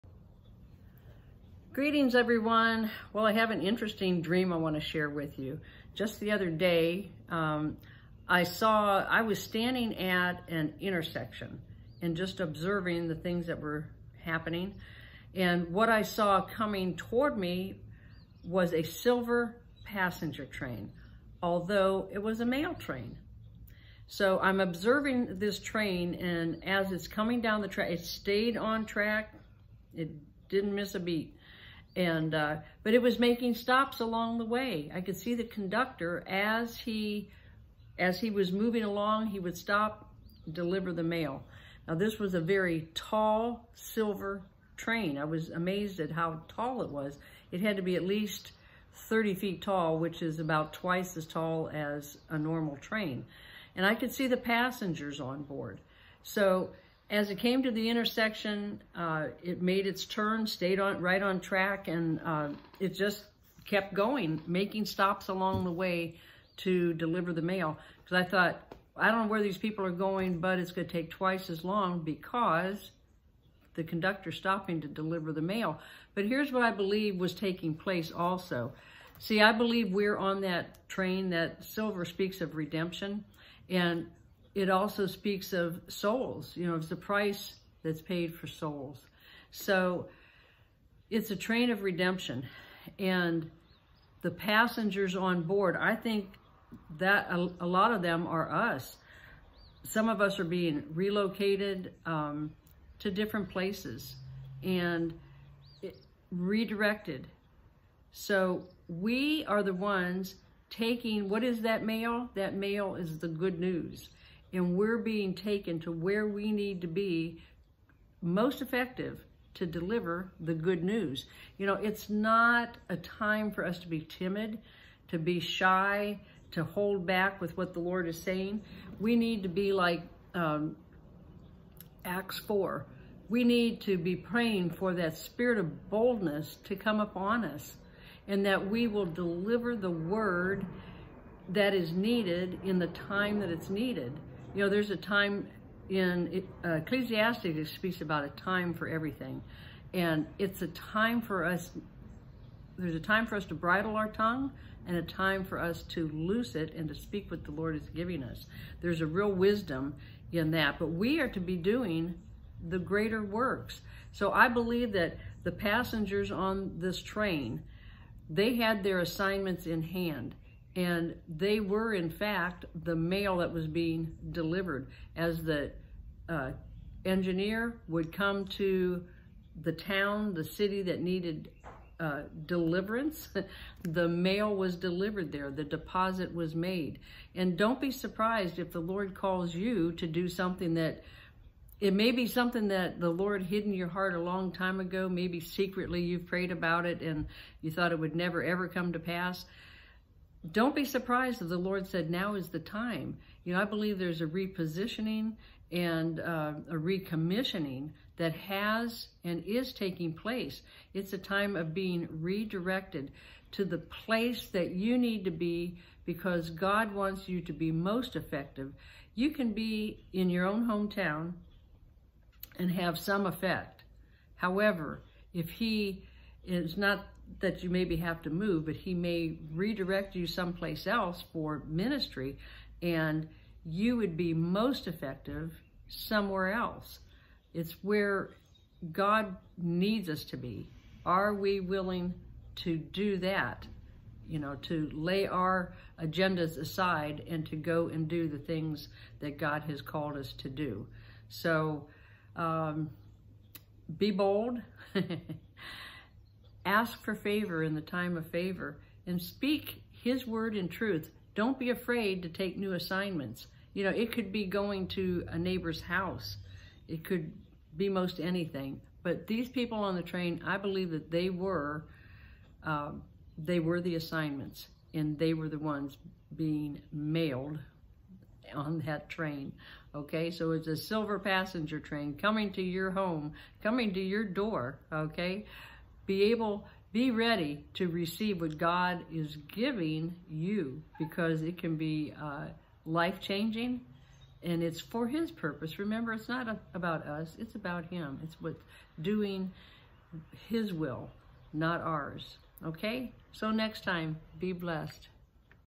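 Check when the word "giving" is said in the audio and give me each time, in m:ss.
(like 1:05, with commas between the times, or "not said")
2:37, 4:49.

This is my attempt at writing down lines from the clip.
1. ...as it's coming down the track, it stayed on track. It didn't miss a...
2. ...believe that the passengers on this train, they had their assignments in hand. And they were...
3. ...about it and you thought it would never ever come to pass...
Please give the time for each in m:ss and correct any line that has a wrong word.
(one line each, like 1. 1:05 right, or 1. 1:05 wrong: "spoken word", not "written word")
1. 0:26 right
2. 2:44 right
3. 3:16 right.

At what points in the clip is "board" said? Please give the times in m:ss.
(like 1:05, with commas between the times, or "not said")
0:55, 1:35.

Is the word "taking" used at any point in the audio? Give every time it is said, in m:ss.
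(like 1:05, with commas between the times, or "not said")
1:17, 1:50, 3:29.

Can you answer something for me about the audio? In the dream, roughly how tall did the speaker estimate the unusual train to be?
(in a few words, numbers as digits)
30 feet.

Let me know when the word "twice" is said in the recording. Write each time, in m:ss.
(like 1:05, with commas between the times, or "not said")
0:50, 1:11.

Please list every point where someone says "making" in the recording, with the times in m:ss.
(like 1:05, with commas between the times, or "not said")
0:33, 1:04.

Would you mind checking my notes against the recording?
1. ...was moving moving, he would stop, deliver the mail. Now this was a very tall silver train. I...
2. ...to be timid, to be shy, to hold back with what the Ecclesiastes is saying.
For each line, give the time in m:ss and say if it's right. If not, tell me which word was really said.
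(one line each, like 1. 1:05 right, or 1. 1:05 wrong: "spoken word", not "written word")
1. 0:38 wrong: "along", not "moving"
2. 2:03 wrong: "Lord", not "Ecclesiastes".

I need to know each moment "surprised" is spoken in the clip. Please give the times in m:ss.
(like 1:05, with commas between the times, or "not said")
3:07, 3:20.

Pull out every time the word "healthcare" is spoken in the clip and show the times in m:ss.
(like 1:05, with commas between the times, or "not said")
not said.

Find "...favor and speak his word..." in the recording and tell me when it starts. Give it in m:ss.
4:18.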